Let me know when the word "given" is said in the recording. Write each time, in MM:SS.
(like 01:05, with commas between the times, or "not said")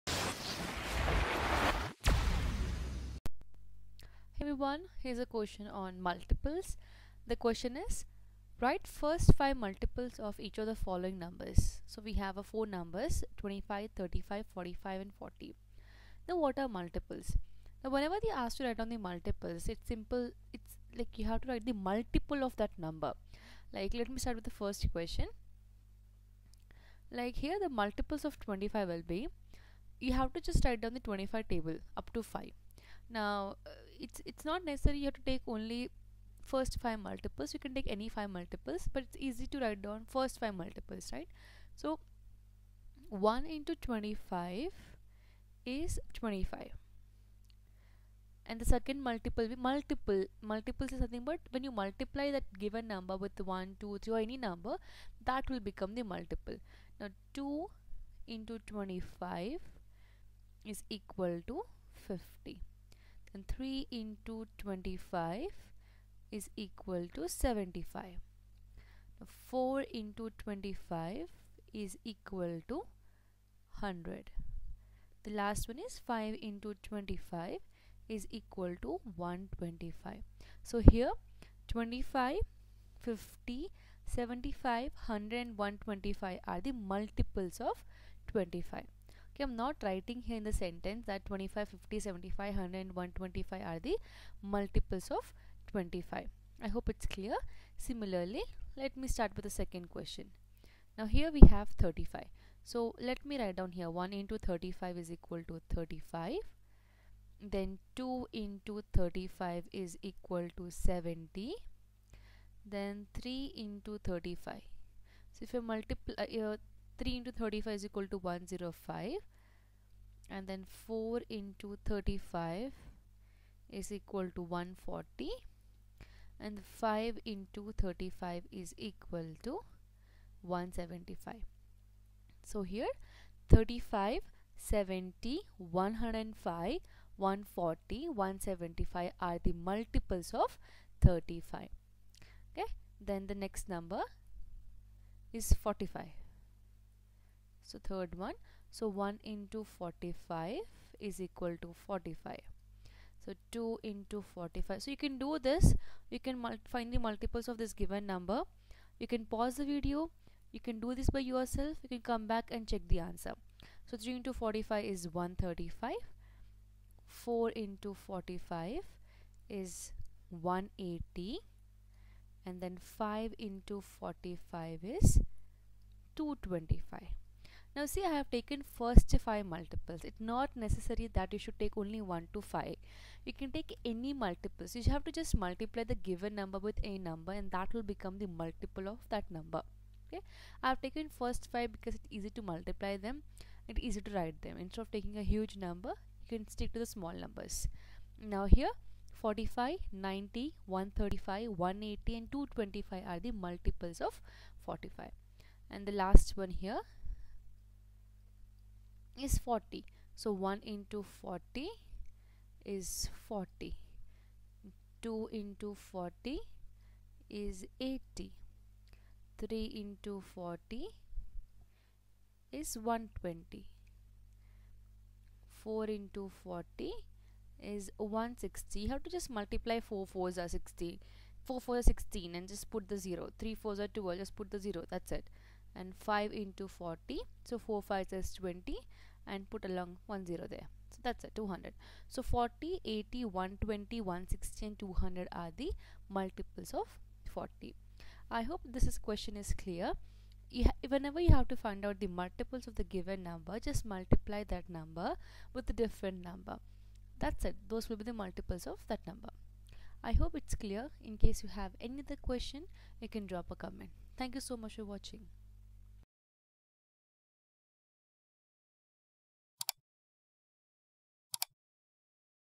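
00:52, 02:37, 03:05, 04:12.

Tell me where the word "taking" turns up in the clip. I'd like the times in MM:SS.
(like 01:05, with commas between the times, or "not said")
03:14.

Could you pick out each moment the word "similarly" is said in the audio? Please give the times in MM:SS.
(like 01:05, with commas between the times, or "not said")
01:37.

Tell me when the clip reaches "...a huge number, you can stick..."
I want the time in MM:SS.
03:15.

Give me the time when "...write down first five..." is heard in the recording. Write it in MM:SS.
00:39.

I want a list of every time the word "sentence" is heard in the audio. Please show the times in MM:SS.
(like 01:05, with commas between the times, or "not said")
01:30.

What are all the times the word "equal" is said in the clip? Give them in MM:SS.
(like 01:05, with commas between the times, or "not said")
01:00, 01:45, 01:50, 02:31.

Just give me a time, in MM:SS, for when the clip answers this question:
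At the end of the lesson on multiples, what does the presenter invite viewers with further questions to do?
04:23.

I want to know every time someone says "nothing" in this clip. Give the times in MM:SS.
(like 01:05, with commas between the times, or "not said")
00:51.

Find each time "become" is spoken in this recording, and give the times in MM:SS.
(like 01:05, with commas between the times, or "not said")
00:55, 03:07.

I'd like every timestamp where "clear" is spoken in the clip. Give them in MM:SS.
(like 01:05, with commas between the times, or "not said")
01:37, 04:09, 04:20.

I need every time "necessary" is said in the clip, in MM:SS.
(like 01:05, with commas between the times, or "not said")
00:34, 03:00.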